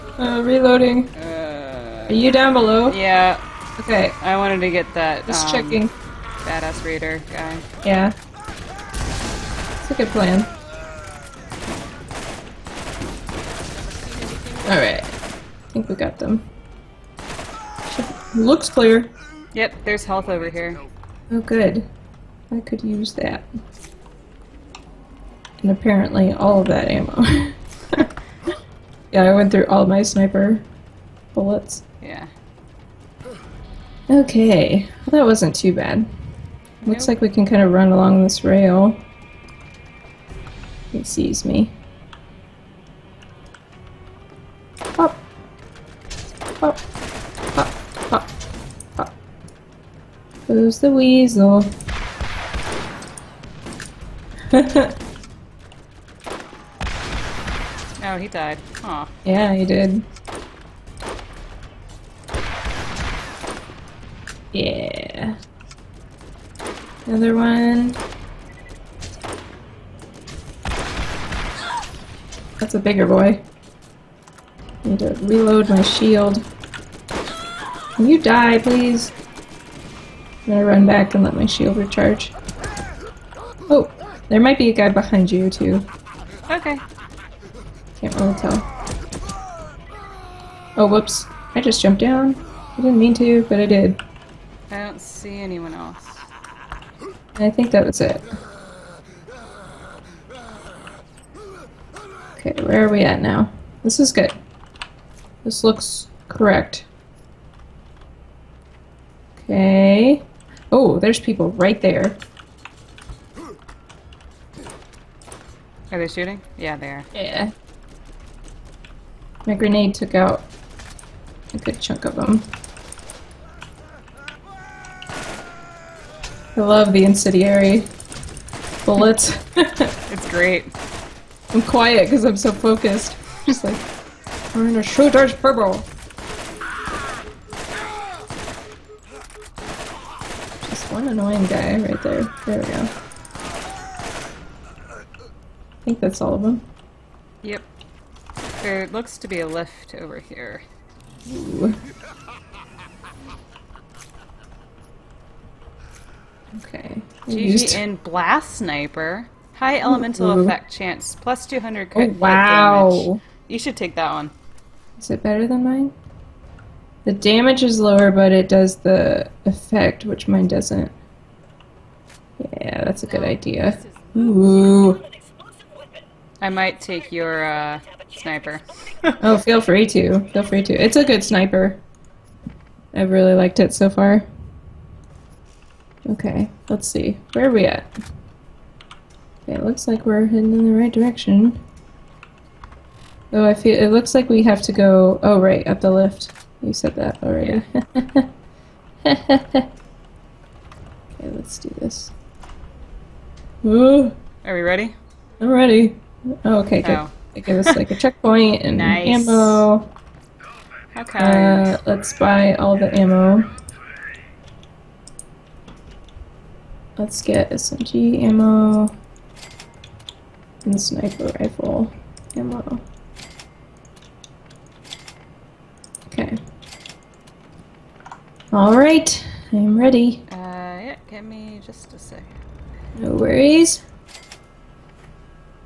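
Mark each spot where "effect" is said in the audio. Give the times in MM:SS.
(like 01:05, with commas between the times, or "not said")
02:40, 02:49.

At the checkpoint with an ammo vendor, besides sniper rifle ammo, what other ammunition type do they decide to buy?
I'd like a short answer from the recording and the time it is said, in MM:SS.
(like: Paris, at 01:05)
SMG ammo, at 03:37.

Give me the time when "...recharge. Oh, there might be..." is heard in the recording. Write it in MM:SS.
01:21.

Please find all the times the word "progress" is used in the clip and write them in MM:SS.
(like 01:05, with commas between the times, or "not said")
not said.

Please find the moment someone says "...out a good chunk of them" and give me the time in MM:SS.
02:00.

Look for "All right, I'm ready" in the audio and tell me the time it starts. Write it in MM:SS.
03:48.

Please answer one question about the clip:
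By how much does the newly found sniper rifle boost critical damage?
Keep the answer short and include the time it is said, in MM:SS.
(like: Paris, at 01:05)
200, at 02:41.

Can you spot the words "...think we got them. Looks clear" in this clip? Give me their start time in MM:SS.
00:15.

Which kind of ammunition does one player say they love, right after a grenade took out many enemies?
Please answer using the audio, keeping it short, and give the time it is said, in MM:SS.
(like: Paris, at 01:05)
incendiary bullets, at 02:07.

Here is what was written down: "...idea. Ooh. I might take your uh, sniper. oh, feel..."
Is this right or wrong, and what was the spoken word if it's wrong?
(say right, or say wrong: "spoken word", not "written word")
right.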